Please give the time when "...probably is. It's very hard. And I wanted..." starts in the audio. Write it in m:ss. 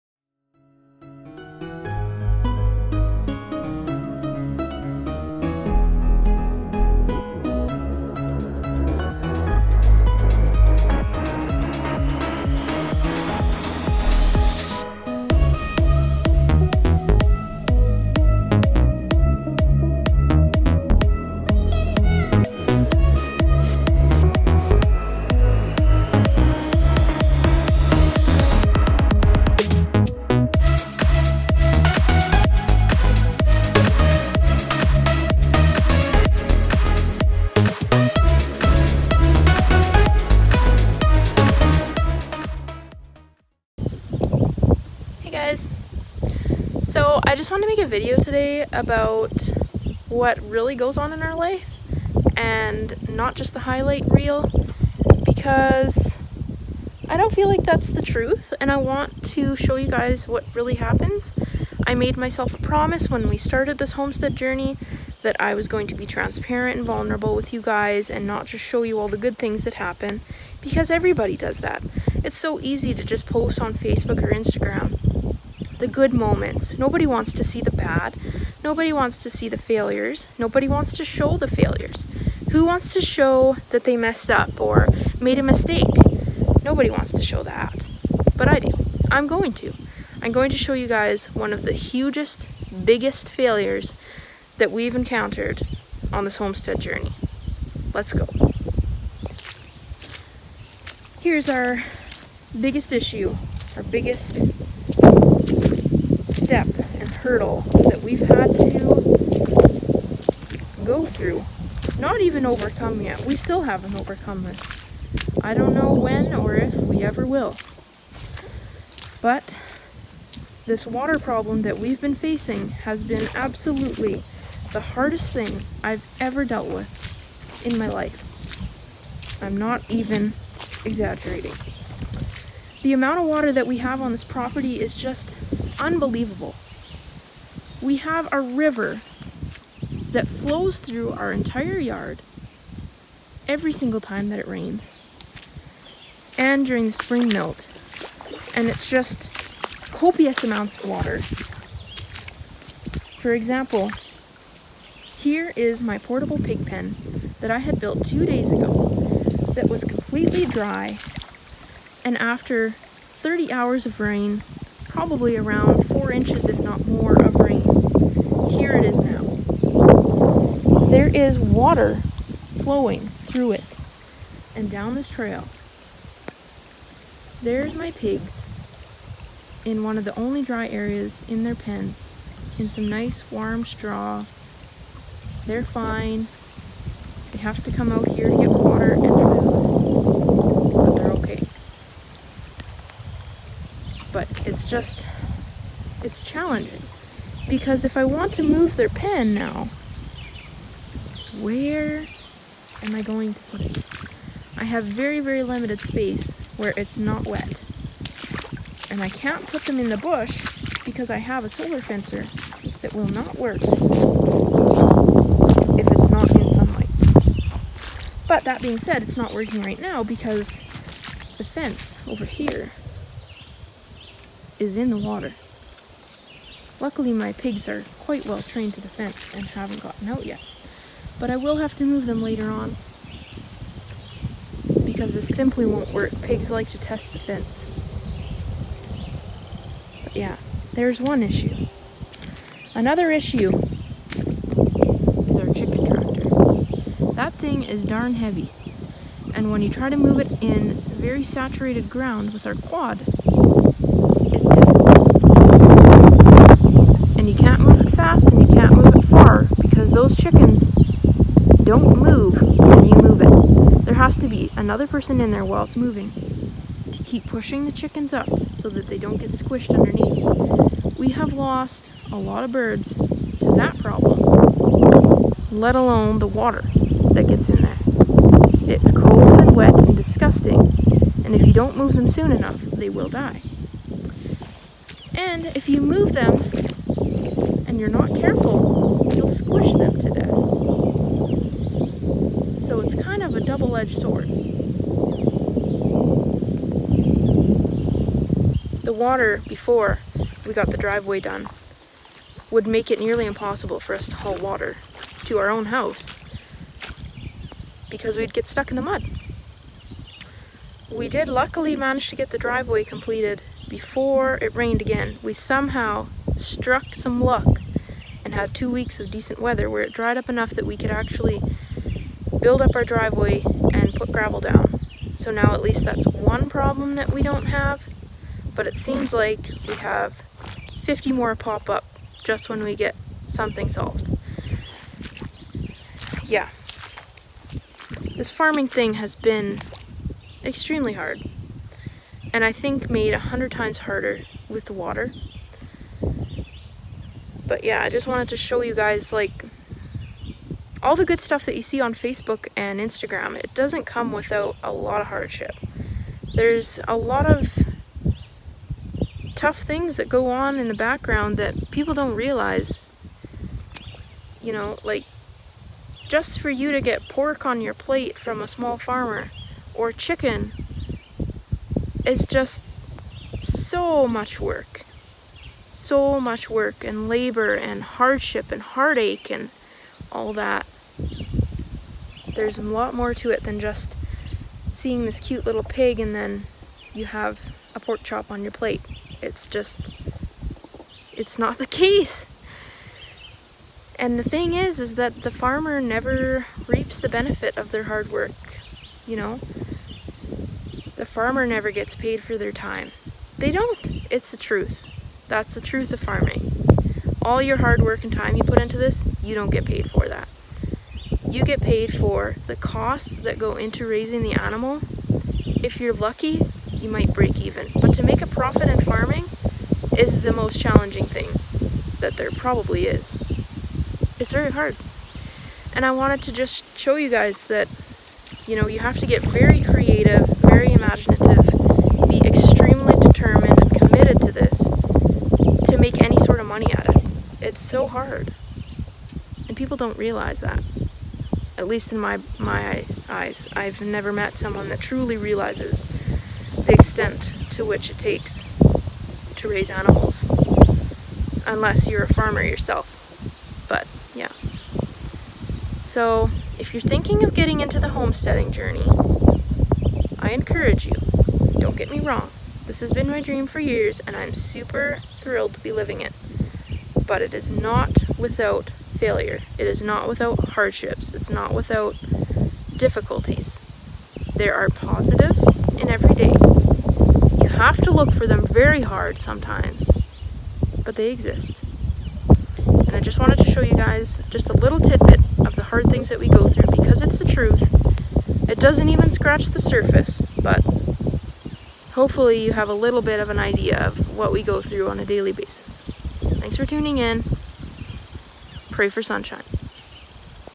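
7:02.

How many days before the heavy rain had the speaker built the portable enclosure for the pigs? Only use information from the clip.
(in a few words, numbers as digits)
2.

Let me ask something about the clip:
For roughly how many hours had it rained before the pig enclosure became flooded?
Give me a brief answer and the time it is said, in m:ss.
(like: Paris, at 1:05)
30, at 2:43.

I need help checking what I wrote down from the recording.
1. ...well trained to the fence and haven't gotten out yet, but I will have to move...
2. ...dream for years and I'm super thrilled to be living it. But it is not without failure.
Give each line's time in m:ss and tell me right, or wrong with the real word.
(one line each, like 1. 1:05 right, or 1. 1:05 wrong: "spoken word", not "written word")
1. 3:48 right
2. 7:43 right.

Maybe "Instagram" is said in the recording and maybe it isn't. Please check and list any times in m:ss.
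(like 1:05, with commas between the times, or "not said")
1:14, 5:52.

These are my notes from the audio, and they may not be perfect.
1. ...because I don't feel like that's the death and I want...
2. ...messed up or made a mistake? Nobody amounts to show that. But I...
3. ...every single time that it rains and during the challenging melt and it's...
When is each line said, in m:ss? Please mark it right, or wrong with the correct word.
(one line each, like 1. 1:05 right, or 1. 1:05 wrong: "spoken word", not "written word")
1. 0:55 wrong: "truth", not "death"
2. 1:23 wrong: "wants", not "amounts"
3. 2:23 wrong: "spring", not "challenging".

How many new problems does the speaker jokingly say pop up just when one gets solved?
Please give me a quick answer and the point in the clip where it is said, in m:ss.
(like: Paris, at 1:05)
50, at 5:30.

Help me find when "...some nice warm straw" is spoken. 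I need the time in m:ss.
3:02.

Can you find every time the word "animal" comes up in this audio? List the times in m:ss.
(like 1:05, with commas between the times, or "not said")
6:54, 7:29.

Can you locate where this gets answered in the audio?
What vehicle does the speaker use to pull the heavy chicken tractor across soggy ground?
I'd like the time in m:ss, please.
4:12.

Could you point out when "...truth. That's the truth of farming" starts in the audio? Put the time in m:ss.
6:44.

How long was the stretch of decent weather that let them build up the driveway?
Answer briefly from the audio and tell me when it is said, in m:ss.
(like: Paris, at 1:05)
2 weeks, at 5:18.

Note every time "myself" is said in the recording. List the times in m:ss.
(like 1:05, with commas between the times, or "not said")
1:02.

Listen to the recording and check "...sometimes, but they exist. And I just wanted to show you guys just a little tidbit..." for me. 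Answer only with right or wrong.
right.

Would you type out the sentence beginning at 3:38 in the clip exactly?
But that being said, it's not working right now because the fence over here is in the water.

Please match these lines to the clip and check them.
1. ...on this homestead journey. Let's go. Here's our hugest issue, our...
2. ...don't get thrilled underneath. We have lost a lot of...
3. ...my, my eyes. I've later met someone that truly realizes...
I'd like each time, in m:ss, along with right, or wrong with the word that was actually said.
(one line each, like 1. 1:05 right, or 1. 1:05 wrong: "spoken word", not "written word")
1. 1:36 wrong: "biggest", not "hugest"
2. 4:28 wrong: "squished", not "thrilled"
3. 7:21 wrong: "never", not "later".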